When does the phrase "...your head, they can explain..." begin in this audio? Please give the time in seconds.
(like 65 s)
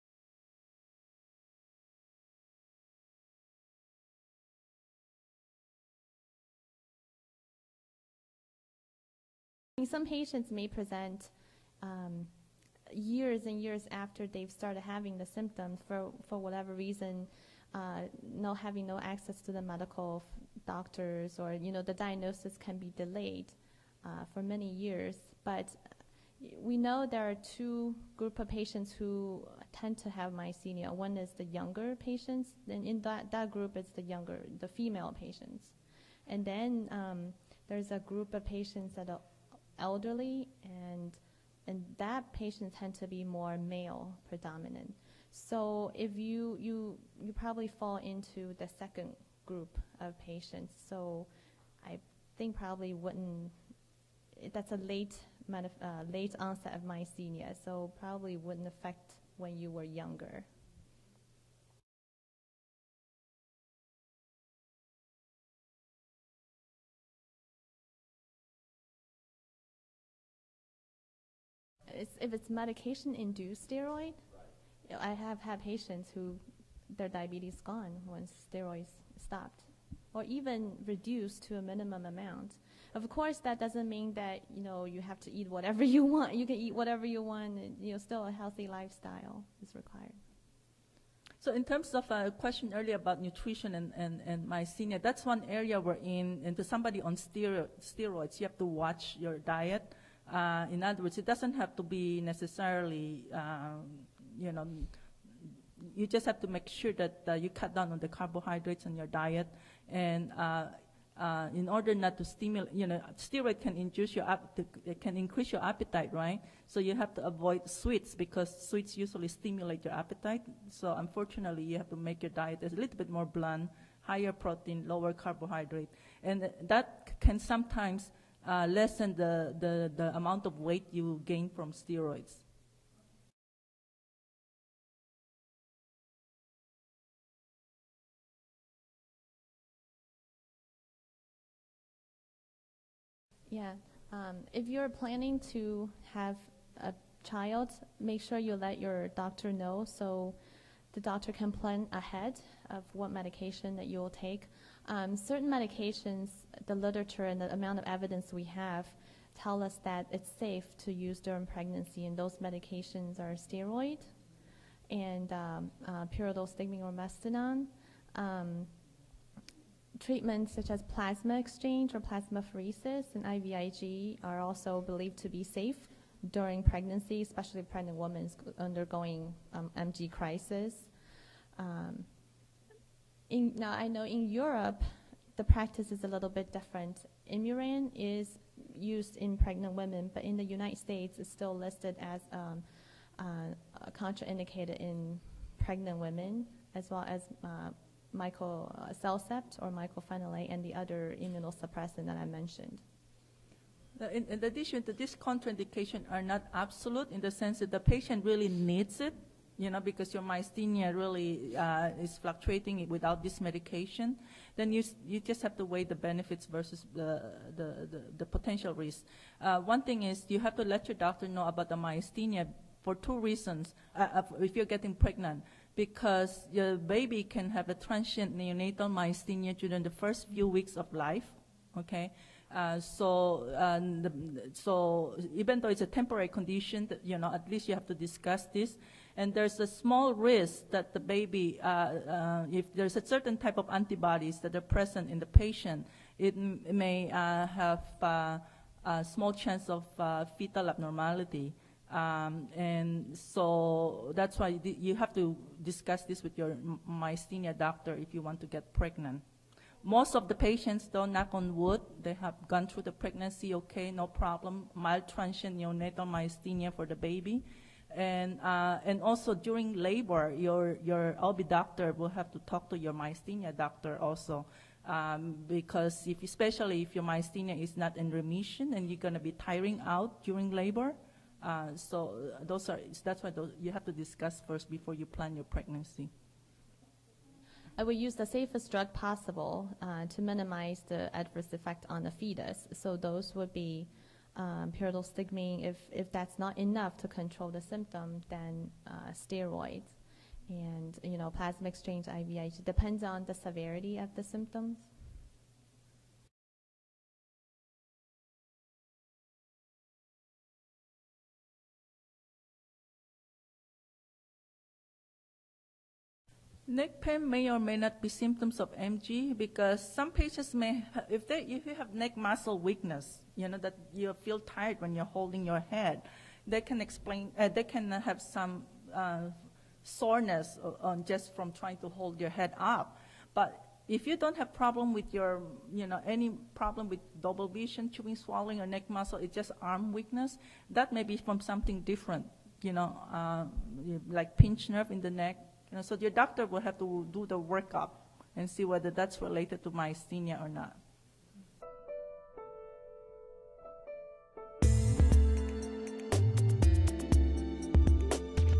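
325 s.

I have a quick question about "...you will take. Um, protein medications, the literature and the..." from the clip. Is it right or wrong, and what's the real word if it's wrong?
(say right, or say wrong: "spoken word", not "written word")
wrong: "certain", not "protein".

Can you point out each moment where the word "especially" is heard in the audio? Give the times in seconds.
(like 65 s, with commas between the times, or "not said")
177 s, 276 s.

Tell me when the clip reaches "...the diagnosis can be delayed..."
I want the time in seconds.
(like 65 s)
21 s.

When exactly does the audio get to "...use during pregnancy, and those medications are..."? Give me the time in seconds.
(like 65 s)
160 s.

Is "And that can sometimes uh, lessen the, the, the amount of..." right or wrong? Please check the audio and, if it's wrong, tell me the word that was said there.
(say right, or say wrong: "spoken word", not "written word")
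right.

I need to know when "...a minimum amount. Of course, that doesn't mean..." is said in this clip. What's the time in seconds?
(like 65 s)
81 s.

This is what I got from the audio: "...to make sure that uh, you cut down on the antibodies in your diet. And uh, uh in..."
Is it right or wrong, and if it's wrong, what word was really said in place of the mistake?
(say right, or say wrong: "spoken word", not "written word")
wrong: "carbohydrates", not "antibodies".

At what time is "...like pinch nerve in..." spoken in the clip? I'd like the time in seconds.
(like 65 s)
344 s.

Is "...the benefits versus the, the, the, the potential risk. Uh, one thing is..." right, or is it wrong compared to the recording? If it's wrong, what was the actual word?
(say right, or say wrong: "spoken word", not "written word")
right.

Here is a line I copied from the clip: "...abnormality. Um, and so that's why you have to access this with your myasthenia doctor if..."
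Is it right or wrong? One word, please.
wrong.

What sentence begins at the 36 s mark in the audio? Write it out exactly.
And then um, there's a group of patients that are elderly, and and that patient tend to be more male predominant.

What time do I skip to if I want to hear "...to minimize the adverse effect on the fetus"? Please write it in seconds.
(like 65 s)
290 s.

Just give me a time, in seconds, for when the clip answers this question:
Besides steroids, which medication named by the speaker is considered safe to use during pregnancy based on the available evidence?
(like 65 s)
166 s.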